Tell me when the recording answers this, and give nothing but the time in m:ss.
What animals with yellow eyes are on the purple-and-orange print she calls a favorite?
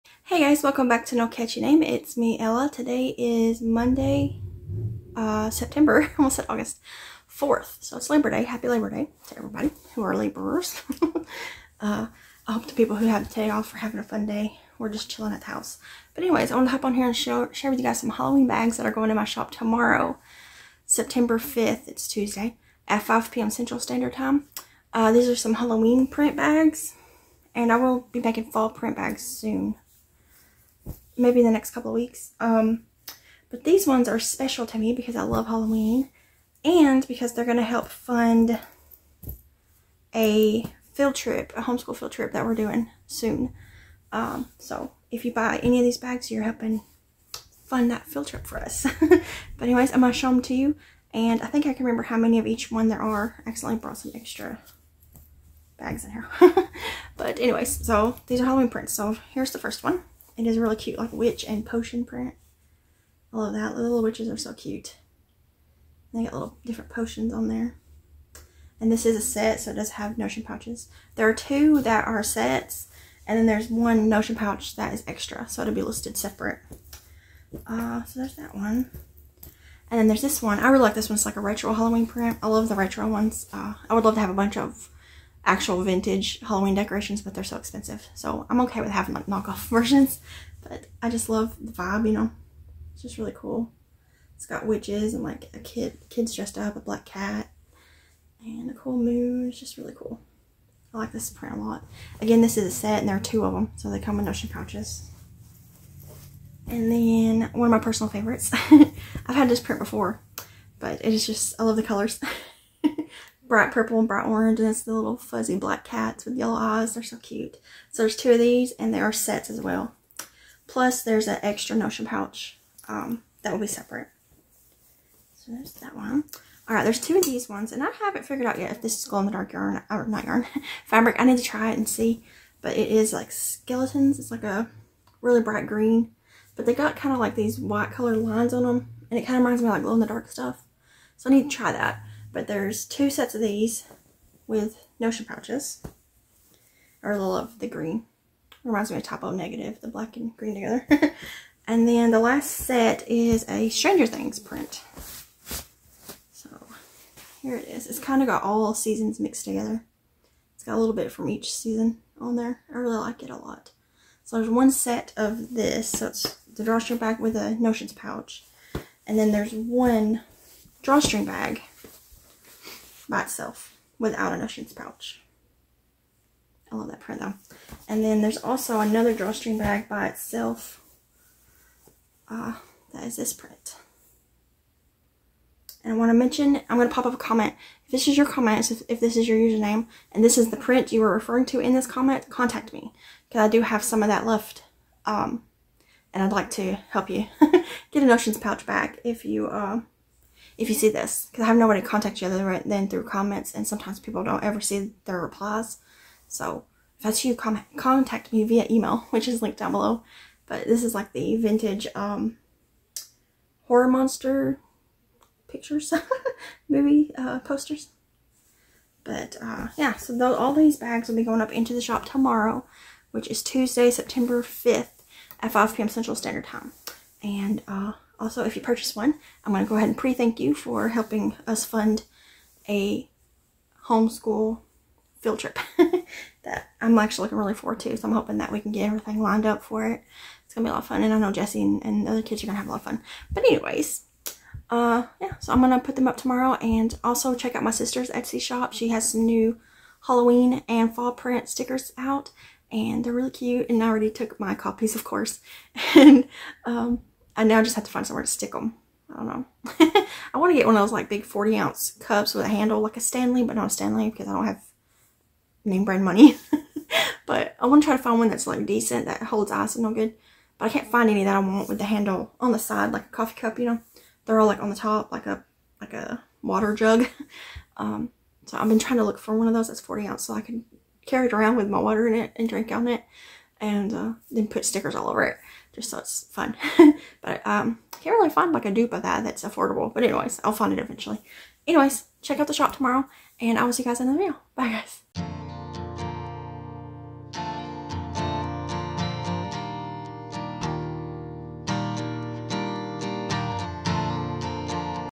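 1:55.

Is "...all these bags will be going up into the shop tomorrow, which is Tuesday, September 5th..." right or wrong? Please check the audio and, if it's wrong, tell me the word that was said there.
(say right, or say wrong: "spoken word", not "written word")
right.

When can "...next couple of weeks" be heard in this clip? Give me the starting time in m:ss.
0:31.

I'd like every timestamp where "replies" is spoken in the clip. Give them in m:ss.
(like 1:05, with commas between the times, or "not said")
3:25.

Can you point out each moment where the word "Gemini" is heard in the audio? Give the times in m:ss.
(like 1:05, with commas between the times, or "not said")
not said.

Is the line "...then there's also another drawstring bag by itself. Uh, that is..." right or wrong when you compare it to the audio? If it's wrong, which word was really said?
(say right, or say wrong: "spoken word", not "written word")
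right.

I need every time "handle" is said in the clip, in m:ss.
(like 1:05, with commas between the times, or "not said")
4:22, 4:31.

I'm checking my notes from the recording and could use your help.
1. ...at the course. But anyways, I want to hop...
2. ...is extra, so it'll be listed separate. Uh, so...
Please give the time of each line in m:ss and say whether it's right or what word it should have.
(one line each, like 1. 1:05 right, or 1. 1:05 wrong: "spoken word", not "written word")
1. 0:15 wrong: "house", not "course"
2. 1:14 right.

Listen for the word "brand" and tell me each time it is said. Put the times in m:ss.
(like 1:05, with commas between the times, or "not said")
4:25.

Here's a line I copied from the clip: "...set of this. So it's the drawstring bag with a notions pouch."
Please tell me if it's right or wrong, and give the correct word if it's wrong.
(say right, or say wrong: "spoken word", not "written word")
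right.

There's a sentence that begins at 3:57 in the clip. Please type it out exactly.
So I'm hoping that we can get everything lined up for it.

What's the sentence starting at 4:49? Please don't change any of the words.
But anyways, I'll find it eventually.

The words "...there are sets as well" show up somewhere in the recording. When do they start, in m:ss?
1:58.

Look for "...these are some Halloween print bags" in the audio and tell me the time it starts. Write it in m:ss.
0:25.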